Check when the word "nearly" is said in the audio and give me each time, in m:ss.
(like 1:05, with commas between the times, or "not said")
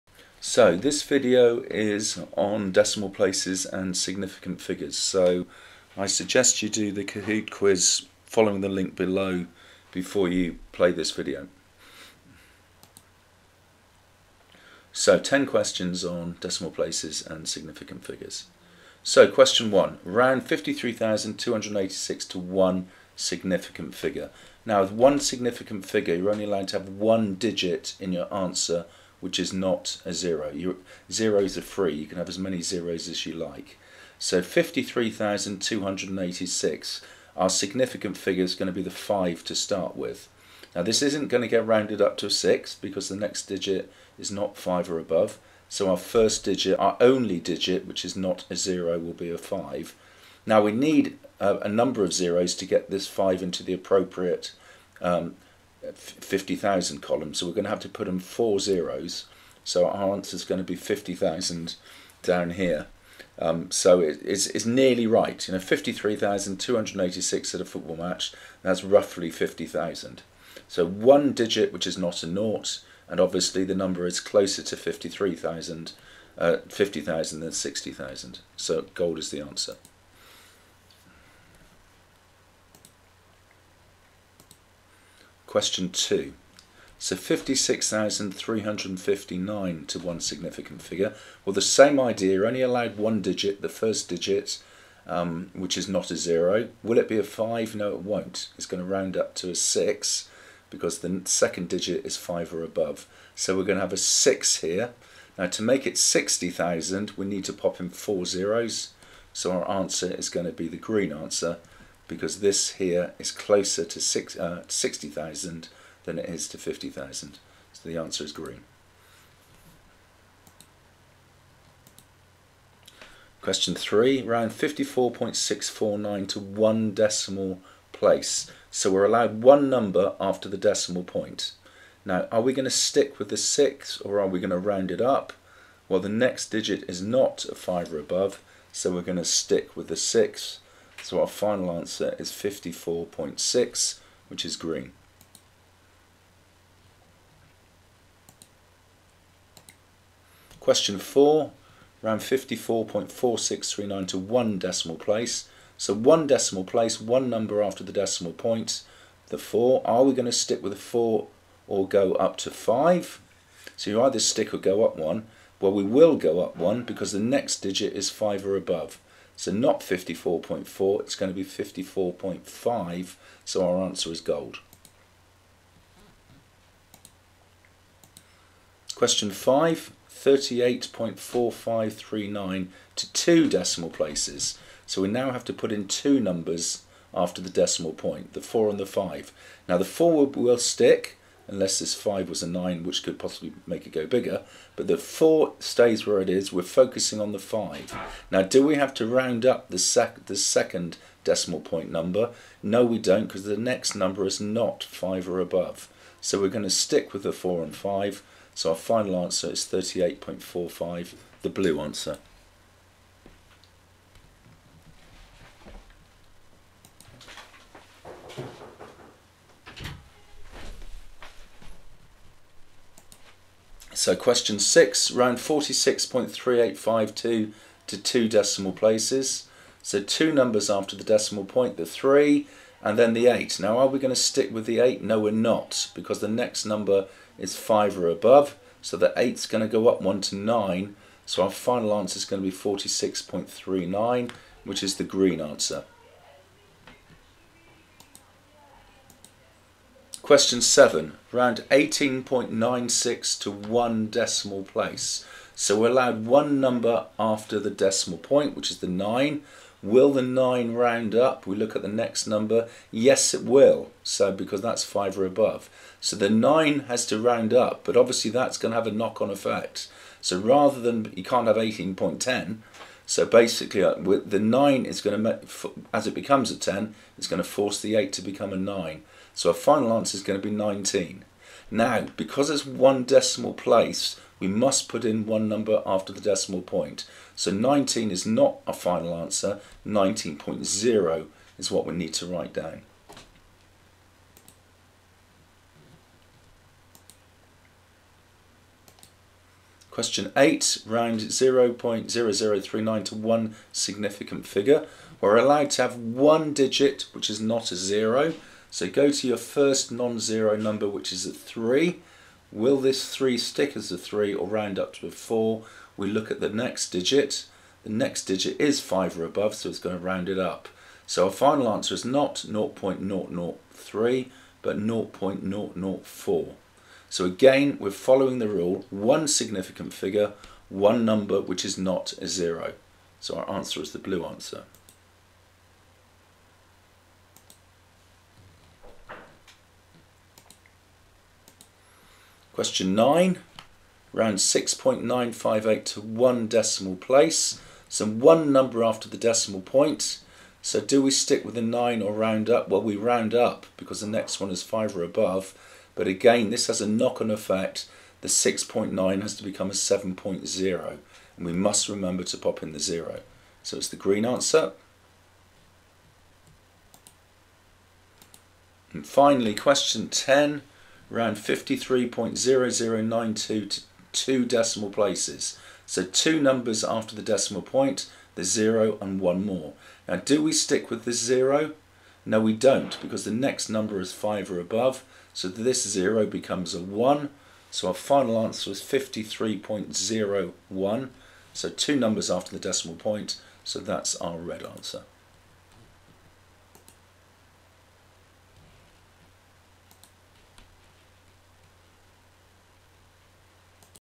1:04.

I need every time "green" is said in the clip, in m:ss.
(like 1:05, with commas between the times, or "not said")
1:50, 1:58, 2:24, 4:05, 6:03.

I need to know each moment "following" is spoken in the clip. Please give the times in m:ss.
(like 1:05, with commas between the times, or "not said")
0:08, 5:27.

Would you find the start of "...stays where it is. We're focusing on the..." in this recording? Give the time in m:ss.
3:15.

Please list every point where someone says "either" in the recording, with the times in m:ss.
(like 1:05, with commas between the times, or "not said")
2:44.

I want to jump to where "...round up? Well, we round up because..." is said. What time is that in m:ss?
5:52.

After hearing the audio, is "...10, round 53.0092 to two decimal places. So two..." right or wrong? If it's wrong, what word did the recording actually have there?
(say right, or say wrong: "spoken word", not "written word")
right.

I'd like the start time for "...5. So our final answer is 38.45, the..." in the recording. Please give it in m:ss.
3:27.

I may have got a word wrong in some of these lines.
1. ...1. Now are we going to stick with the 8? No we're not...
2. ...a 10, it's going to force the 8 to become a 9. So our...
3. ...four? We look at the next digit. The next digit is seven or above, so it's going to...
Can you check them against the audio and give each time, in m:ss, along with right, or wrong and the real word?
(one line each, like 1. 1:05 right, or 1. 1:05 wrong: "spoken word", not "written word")
1. 3:53 wrong: "8", not "1"
2. 4:36 right
3. 5:15 wrong: "five", not "seven".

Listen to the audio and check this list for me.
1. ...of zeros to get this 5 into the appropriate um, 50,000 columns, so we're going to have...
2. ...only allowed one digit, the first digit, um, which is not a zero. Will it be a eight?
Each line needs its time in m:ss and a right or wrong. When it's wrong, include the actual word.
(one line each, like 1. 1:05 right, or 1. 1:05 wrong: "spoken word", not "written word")
1. 0:52 right
2. 1:32 wrong: "five", not "eight".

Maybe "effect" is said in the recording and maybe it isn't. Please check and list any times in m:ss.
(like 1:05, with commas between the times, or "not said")
4:29, 5:57.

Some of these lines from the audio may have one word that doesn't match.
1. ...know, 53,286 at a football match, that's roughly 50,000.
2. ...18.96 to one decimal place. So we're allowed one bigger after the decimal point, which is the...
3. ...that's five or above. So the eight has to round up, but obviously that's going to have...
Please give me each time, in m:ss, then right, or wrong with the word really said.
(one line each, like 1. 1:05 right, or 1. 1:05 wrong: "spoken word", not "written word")
1. 1:05 right
2. 4:11 wrong: "number", not "bigger"
3. 4:24 wrong: "nine", not "eight".